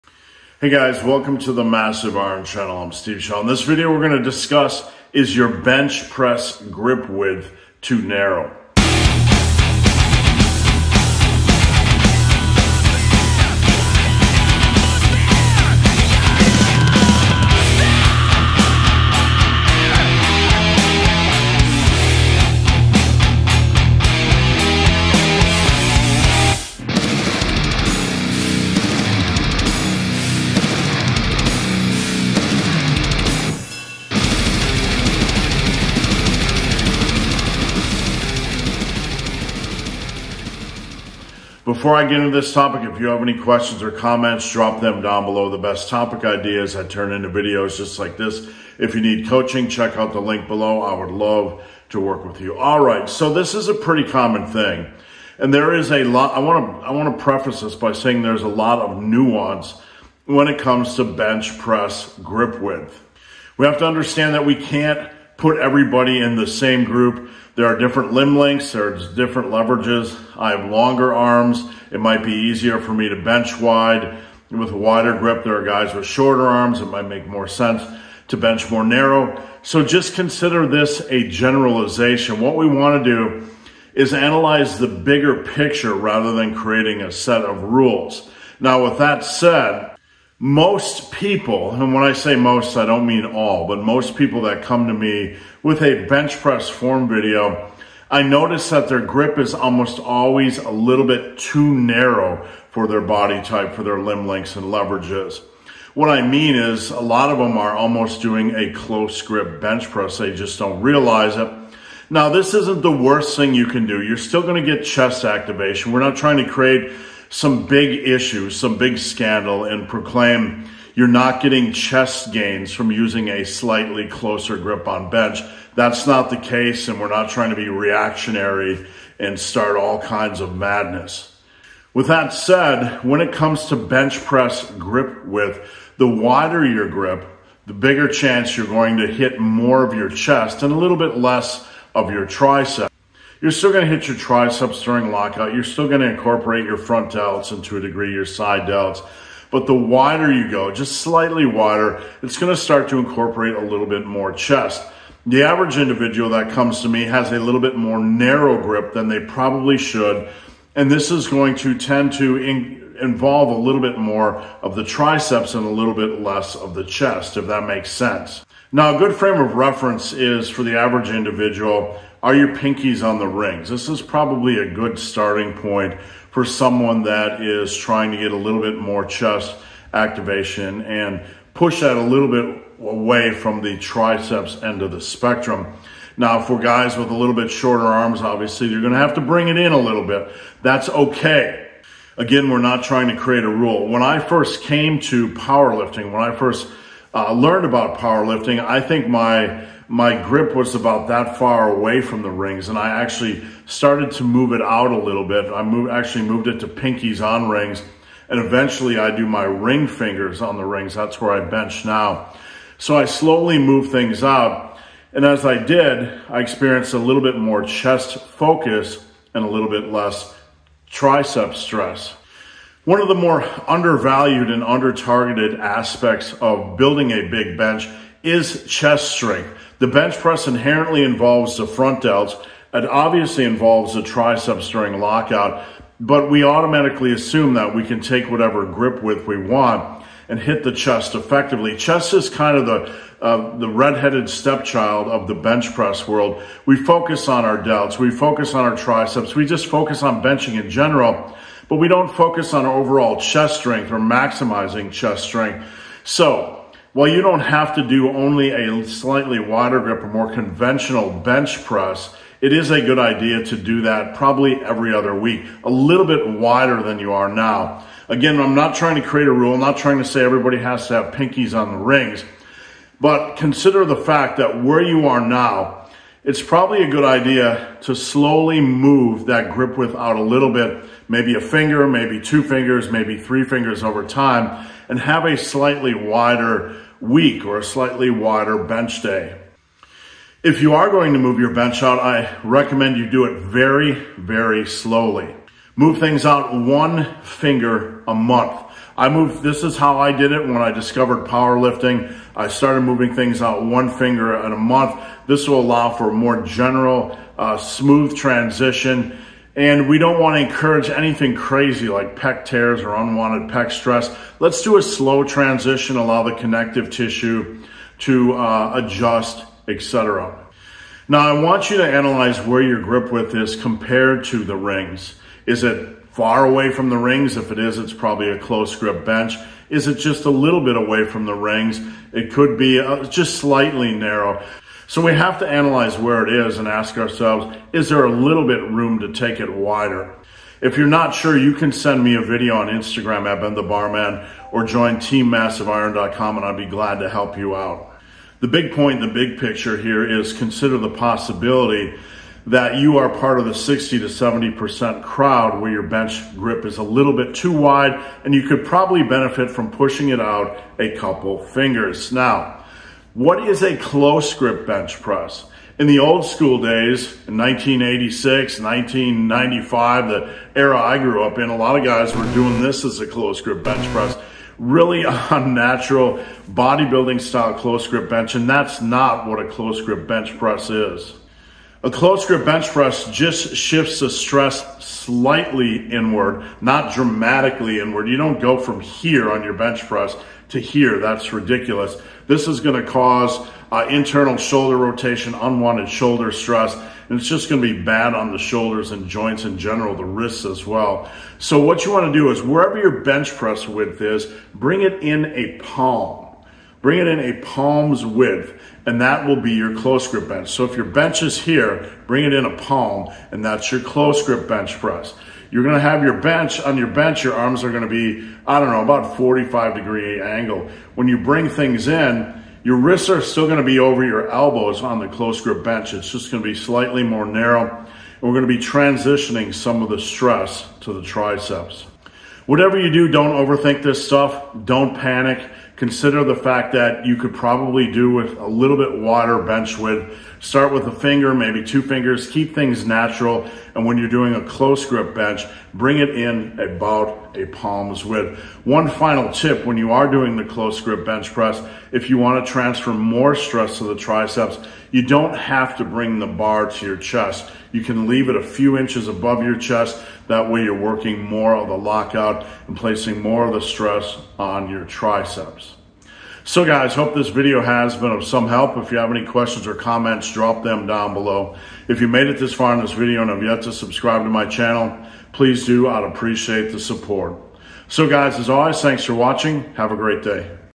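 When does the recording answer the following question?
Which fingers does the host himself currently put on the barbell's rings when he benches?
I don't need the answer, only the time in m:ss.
3:29.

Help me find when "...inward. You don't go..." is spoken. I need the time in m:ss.
6:27.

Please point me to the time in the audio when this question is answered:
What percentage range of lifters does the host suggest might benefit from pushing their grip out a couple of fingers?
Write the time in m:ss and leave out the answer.
5:53.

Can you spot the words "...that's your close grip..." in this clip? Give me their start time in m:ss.
6:53.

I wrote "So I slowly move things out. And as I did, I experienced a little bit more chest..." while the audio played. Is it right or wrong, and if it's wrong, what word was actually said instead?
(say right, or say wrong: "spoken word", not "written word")
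right.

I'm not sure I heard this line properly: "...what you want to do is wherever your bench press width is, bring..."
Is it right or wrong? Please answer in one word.
right.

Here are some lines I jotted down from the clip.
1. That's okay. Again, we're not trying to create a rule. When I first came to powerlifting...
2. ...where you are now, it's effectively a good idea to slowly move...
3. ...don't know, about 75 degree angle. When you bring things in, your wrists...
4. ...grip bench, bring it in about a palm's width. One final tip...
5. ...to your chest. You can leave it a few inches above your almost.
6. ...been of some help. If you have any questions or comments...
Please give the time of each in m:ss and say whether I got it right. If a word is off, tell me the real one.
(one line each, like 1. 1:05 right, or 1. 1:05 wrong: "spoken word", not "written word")
1. 3:10 right
2. 4:34 wrong: "probably", not "effectively"
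3. 6:58 wrong: "45", not "75"
4. 7:24 right
5. 7:36 wrong: "chest", not "almost"
6. 7:47 right.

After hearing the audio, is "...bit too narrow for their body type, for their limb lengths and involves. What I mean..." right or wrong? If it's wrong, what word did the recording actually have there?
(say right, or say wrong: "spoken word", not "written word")
wrong: "leverages", not "involves".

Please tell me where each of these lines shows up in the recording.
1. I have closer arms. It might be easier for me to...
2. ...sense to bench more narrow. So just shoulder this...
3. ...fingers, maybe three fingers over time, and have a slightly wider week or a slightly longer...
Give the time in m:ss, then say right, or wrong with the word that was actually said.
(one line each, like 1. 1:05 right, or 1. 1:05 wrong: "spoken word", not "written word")
1. 1:10 wrong: "longer", not "closer"
2. 1:17 wrong: "consider", not "shoulder"
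3. 4:42 wrong: "wider", not "longer".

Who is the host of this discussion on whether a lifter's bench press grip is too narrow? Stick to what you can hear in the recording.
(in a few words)
Steve Shaw.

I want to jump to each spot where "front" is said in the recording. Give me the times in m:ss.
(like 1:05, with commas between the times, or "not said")
2:26, 3:51.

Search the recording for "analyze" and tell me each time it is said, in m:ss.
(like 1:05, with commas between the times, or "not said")
1:24, 5:21, 5:35.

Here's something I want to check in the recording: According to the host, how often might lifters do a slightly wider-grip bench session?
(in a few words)
Every other week.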